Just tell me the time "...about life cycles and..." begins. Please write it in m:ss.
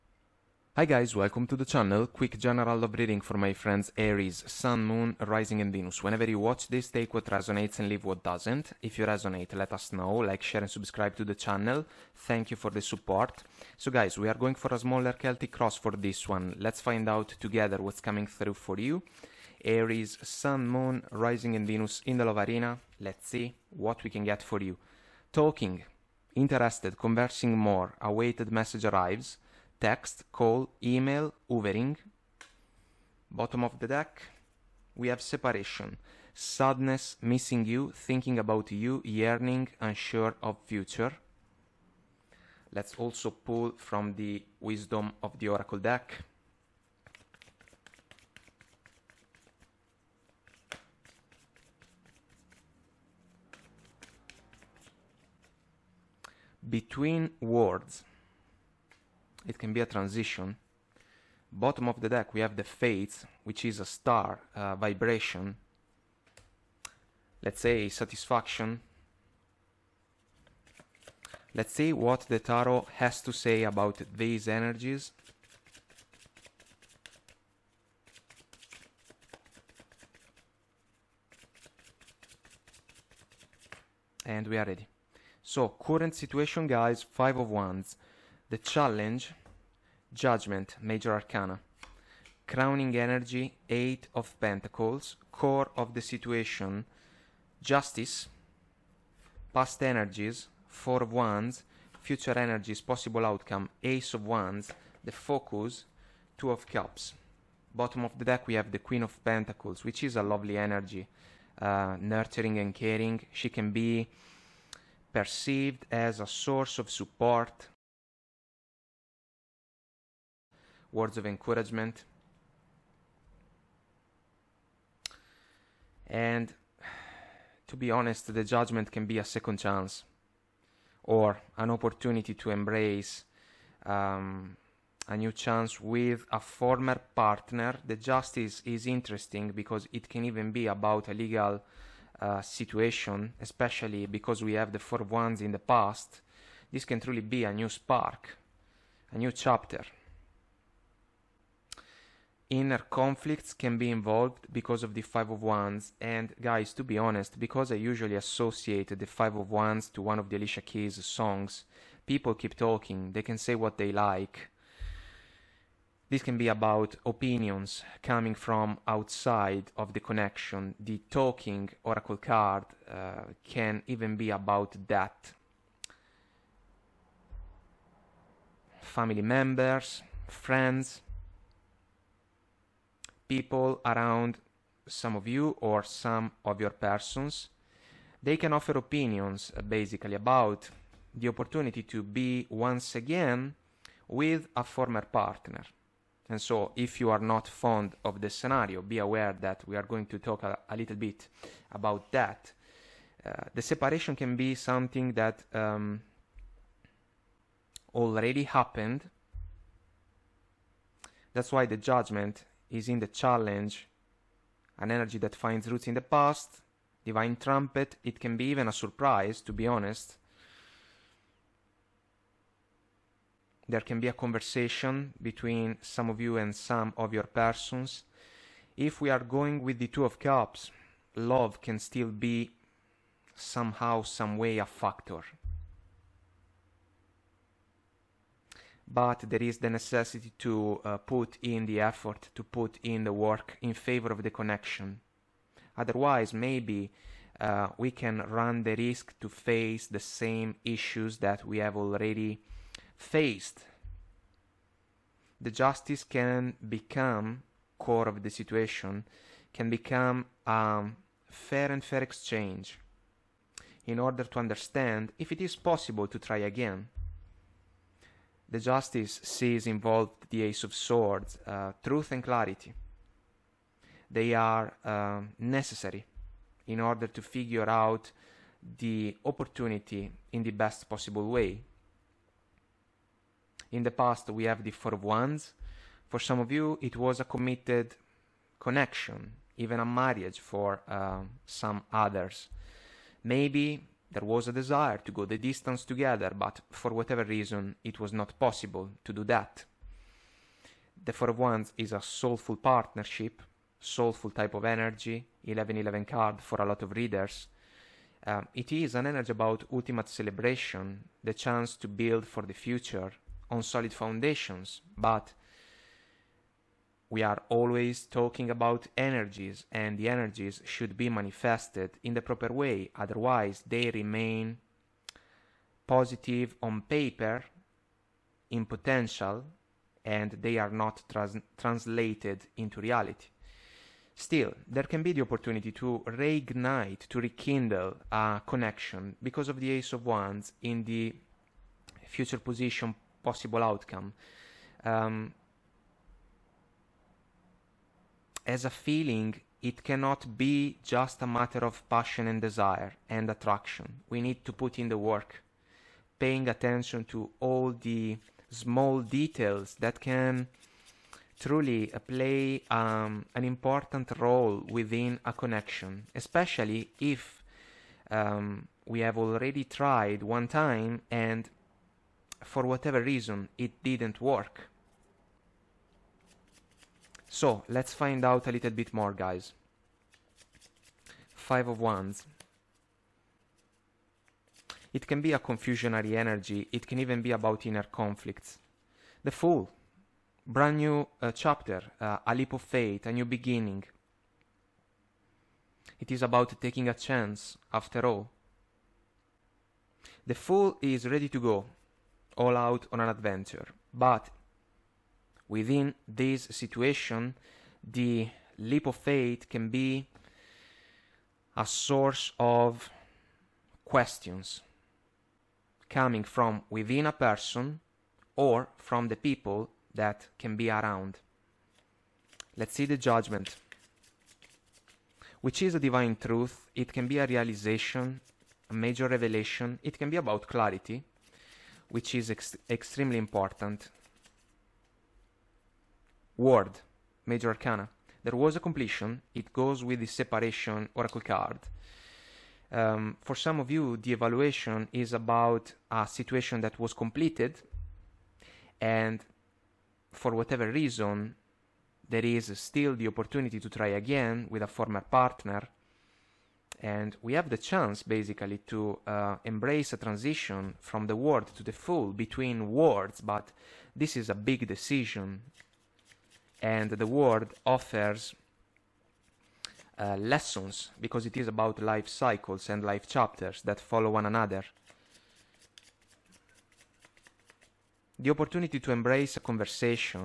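7:51.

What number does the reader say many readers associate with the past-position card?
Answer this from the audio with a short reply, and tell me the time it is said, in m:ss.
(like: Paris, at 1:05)
1111, at 5:05.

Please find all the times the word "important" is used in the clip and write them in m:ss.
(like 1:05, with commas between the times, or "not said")
6:03, 7:13.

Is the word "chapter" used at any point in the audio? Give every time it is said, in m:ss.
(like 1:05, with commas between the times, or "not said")
2:29, 6:31, 7:53.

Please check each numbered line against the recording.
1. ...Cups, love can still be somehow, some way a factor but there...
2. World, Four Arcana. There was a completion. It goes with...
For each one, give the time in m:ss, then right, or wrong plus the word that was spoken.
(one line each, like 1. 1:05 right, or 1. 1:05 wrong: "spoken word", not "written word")
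1. 3:50 right
2. 7:16 wrong: "Major", not "Four".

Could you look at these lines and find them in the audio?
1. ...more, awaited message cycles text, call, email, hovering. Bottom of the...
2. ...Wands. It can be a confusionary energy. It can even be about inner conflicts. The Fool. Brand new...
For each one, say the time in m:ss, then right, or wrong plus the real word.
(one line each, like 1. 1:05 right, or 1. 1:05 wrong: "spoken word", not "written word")
1. 0:27 wrong: "arrives", not "cycles"
2. 6:21 right.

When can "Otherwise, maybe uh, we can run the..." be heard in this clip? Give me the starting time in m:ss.
4:05.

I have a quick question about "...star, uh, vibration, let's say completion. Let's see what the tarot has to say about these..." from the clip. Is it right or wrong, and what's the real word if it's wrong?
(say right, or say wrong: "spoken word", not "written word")
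wrong: "satisfaction", not "completion".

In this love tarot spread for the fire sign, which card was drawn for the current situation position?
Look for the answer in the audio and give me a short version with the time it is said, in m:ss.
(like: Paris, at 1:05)
5 of Wands, at 1:27.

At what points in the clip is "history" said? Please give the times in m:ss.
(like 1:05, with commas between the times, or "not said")
not said.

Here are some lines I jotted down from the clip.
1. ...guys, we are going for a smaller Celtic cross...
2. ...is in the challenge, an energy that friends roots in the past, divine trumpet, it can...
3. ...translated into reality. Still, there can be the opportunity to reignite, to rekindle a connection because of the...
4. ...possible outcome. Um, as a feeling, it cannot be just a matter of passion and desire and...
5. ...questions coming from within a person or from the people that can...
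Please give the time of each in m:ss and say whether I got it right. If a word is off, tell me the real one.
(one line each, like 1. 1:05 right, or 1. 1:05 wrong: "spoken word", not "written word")
1. 0:13 right
2. 3:32 wrong: "finds", not "friends"
3. 5:31 right
4. 5:43 right
5. 6:53 right.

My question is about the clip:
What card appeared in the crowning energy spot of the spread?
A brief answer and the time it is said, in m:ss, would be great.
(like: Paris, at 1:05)
Eight of Pentacles, at 1:33.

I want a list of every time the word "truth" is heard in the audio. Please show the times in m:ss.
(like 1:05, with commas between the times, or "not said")
4:31, 7:06.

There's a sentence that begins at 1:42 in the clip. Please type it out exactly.
Future Energies, Possible Outcome, Ace of Wands.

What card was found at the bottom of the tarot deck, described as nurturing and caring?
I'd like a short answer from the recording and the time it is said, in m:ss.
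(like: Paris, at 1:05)
Queen of Pentacles, at 1:48.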